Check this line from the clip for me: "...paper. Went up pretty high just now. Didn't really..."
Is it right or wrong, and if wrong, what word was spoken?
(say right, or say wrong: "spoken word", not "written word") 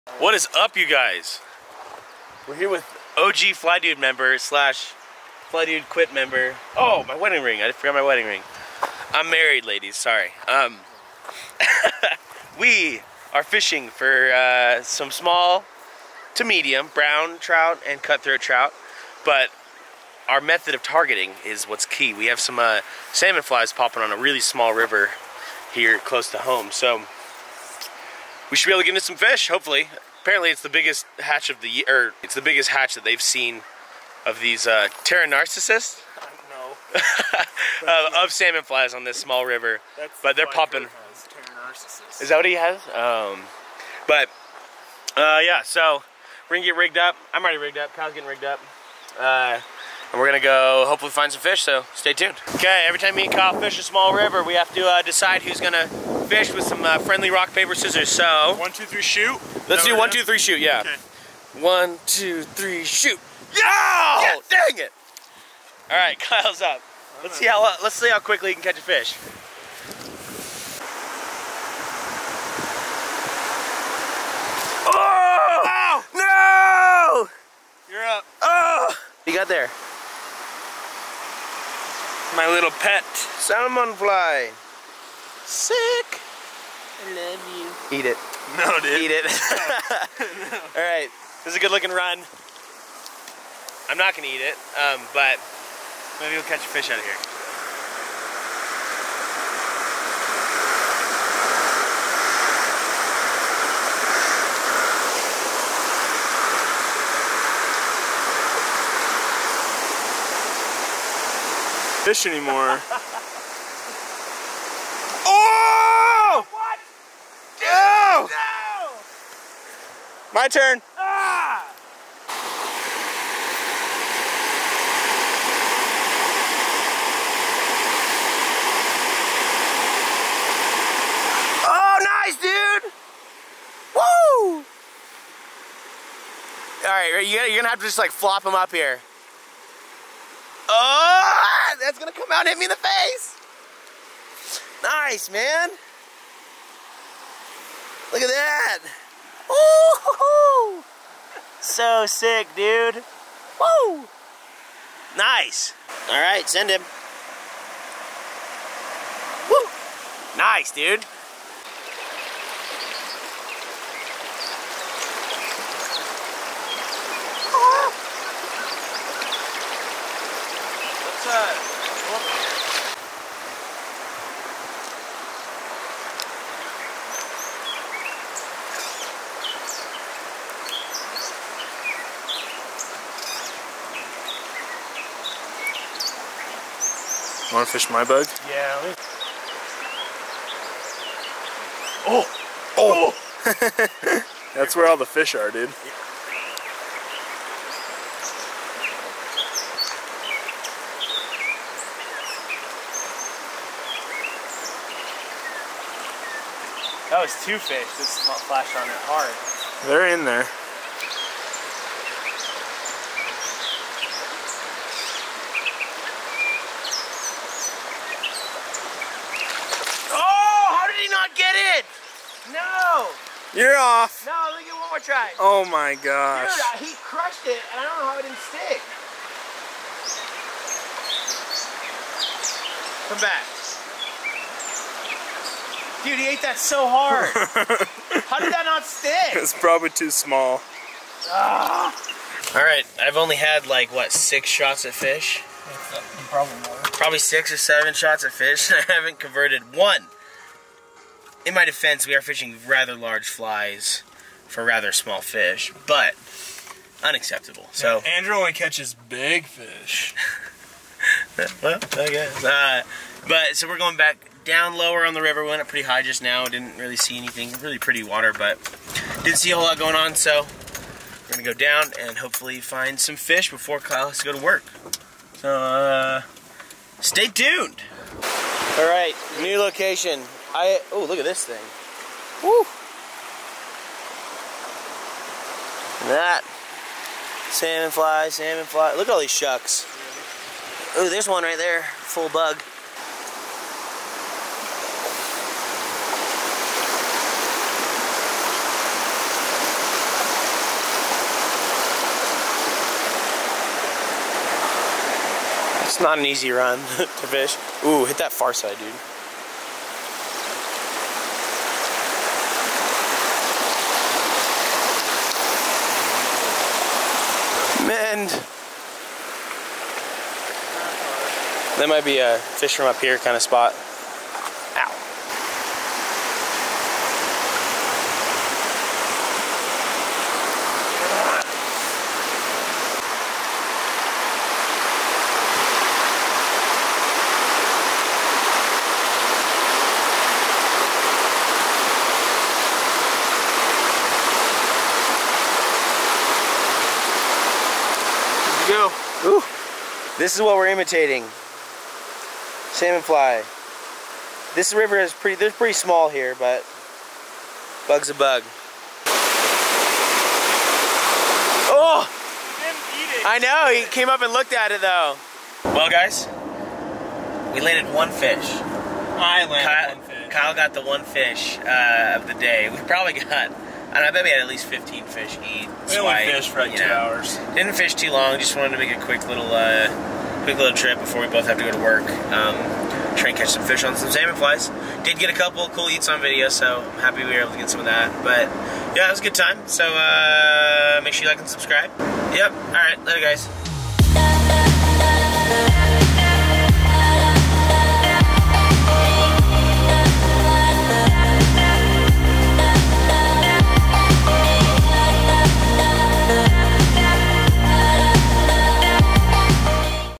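wrong: "river", not "paper".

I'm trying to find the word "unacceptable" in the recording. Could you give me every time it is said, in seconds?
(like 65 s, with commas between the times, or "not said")
257 s.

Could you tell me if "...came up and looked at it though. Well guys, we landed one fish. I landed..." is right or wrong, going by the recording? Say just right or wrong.
right.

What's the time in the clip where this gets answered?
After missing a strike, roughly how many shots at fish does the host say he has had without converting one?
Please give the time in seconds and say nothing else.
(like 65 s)
247 s.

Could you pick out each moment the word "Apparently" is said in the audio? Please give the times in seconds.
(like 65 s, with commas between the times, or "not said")
30 s.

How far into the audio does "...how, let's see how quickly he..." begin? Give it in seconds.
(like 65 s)
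67 s.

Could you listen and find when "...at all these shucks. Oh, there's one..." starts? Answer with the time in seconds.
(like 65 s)
289 s.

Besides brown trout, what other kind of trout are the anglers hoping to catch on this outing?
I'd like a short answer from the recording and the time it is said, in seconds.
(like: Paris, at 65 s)
Cutthroat trout, at 18 s.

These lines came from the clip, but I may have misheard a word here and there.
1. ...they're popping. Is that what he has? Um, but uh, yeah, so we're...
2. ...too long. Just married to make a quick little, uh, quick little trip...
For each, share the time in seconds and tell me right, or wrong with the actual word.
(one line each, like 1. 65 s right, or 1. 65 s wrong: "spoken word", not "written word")
1. 40 s right
2. 377 s wrong: "wanted", not "married".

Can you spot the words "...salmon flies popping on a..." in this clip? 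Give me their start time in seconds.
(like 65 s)
23 s.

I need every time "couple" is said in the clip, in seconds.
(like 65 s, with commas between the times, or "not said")
385 s.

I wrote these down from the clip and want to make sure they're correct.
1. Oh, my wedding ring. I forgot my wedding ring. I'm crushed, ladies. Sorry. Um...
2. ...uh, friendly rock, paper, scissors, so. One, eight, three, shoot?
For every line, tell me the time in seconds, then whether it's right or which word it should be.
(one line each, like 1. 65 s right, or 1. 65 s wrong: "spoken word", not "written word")
1. 6 s wrong: "married", not "crushed"
2. 56 s wrong: "two", not "eight".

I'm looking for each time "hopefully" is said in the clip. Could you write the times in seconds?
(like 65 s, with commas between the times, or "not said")
29 s, 50 s, 272 s.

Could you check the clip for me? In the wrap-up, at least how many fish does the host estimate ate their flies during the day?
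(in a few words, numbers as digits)
15.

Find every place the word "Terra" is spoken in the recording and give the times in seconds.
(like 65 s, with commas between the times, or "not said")
35 s.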